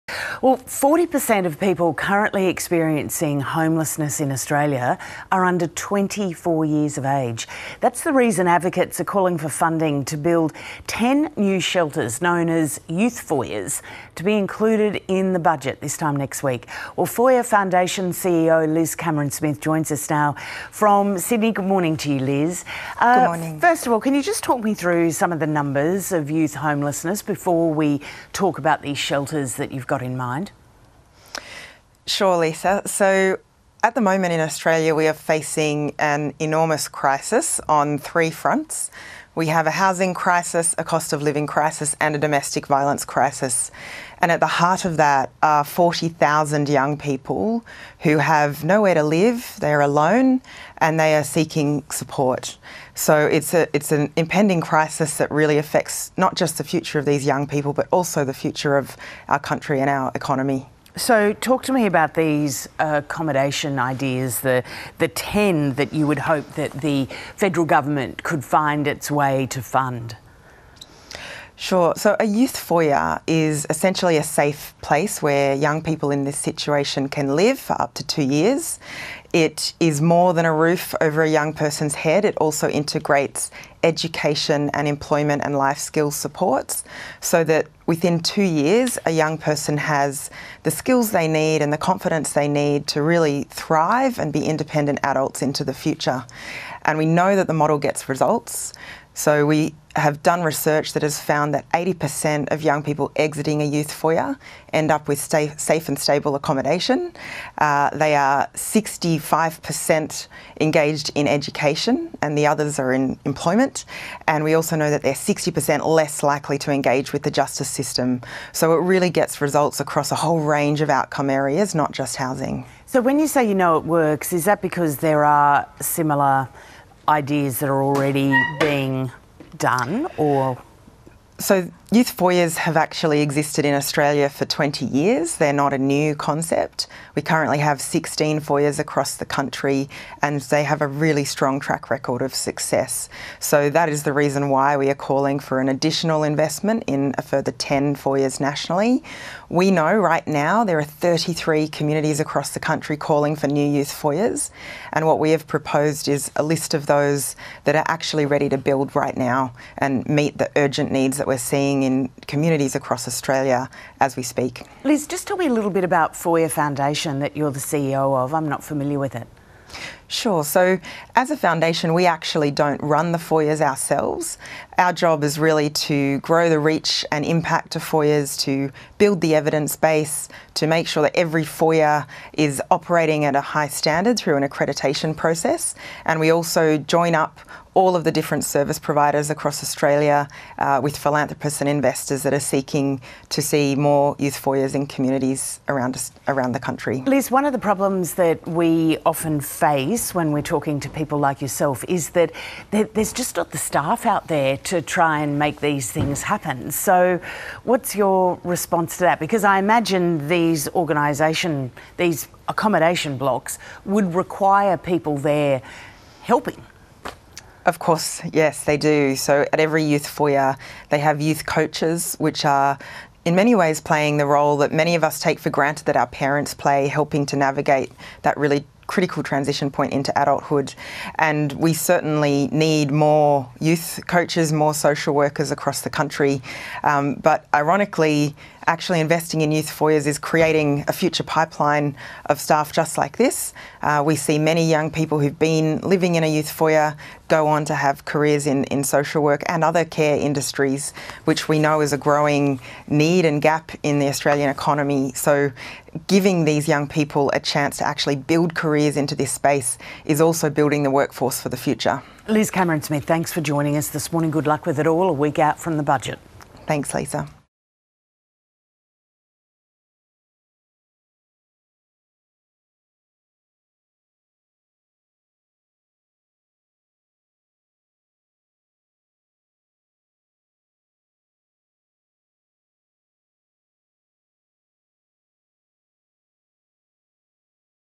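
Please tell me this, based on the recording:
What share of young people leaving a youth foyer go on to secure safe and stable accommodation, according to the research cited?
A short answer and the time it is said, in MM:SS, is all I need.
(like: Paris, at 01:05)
80%, at 01:41.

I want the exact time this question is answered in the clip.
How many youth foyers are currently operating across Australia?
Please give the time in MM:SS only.
02:17.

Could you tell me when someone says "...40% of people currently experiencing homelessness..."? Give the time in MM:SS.
00:00.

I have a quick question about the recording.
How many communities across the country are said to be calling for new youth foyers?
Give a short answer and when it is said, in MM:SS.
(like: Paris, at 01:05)
33, at 02:30.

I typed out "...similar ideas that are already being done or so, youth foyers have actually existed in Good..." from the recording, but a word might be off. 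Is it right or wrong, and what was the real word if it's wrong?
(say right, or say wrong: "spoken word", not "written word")
wrong: "Australia", not "Good".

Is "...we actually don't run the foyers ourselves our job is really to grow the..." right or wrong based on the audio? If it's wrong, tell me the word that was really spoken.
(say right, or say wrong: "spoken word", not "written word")
right.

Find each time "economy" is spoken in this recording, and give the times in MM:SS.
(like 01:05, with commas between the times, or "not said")
01:00, 04:14.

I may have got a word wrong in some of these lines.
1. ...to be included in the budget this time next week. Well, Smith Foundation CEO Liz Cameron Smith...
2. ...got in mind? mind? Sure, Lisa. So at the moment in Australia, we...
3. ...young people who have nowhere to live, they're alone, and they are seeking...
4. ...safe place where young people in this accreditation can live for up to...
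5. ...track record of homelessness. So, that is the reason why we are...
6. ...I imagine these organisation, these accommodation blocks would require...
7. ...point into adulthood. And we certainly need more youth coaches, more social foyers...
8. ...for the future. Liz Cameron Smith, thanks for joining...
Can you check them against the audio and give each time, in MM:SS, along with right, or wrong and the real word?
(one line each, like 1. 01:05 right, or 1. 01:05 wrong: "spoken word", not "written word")
1. 00:14 wrong: "Foyer", not "Smith"
2. 00:29 right
3. 00:46 right
4. 01:14 wrong: "situation", not "accreditation"
5. 02:21 wrong: "success", not "homelessness"
6. 03:29 right
7. 03:49 wrong: "workers", not "foyers"
8. 04:21 right.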